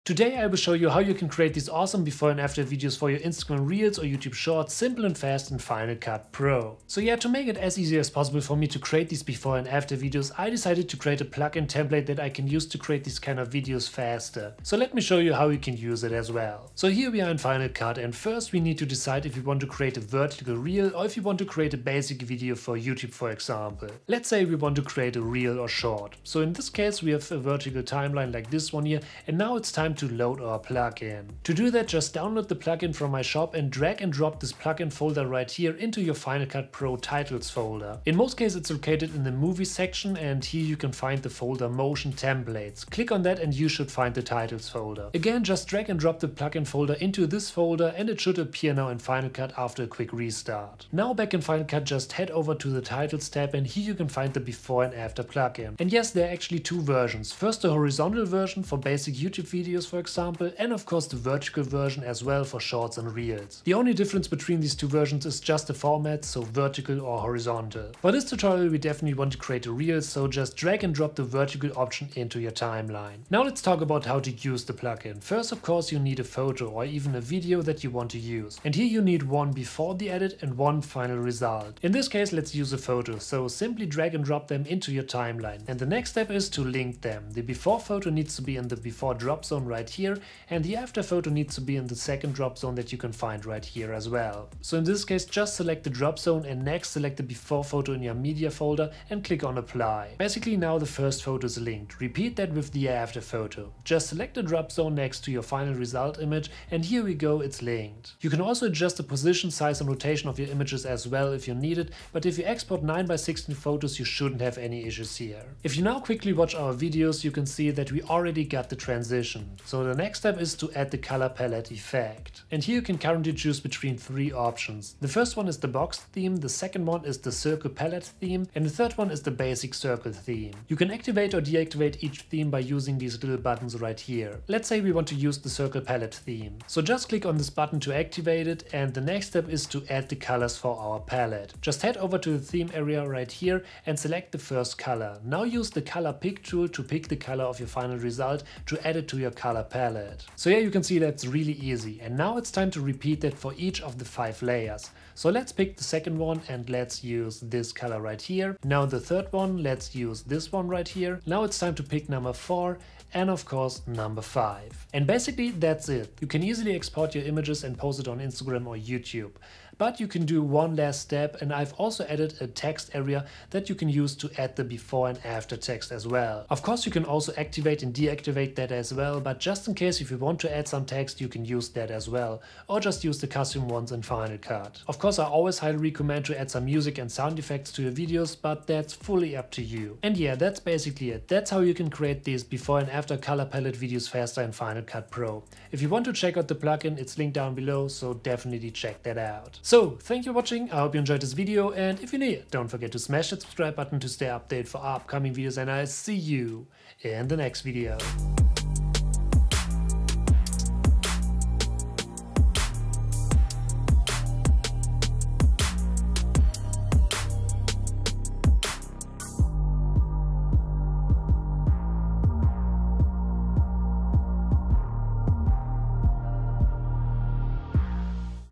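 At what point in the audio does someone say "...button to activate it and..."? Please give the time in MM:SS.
02:17.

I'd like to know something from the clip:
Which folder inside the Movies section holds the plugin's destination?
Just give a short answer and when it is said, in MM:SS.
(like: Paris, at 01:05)
Motion Templates, at 00:41.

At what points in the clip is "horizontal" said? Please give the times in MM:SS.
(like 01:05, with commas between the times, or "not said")
00:57, 01:07.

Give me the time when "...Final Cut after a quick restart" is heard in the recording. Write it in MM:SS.
00:48.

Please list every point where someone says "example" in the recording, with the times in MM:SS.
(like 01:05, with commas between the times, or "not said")
00:23, 00:59.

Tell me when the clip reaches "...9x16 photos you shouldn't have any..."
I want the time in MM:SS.
01:52.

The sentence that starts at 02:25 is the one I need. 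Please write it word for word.
Now use the color pick tool to pick the color of your final result to add it to your color color palette.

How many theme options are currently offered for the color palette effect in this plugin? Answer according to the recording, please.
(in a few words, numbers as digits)
3.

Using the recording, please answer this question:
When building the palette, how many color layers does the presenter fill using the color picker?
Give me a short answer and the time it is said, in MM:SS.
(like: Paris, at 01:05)
5, at 02:34.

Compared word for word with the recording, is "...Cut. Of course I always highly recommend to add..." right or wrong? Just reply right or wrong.
right.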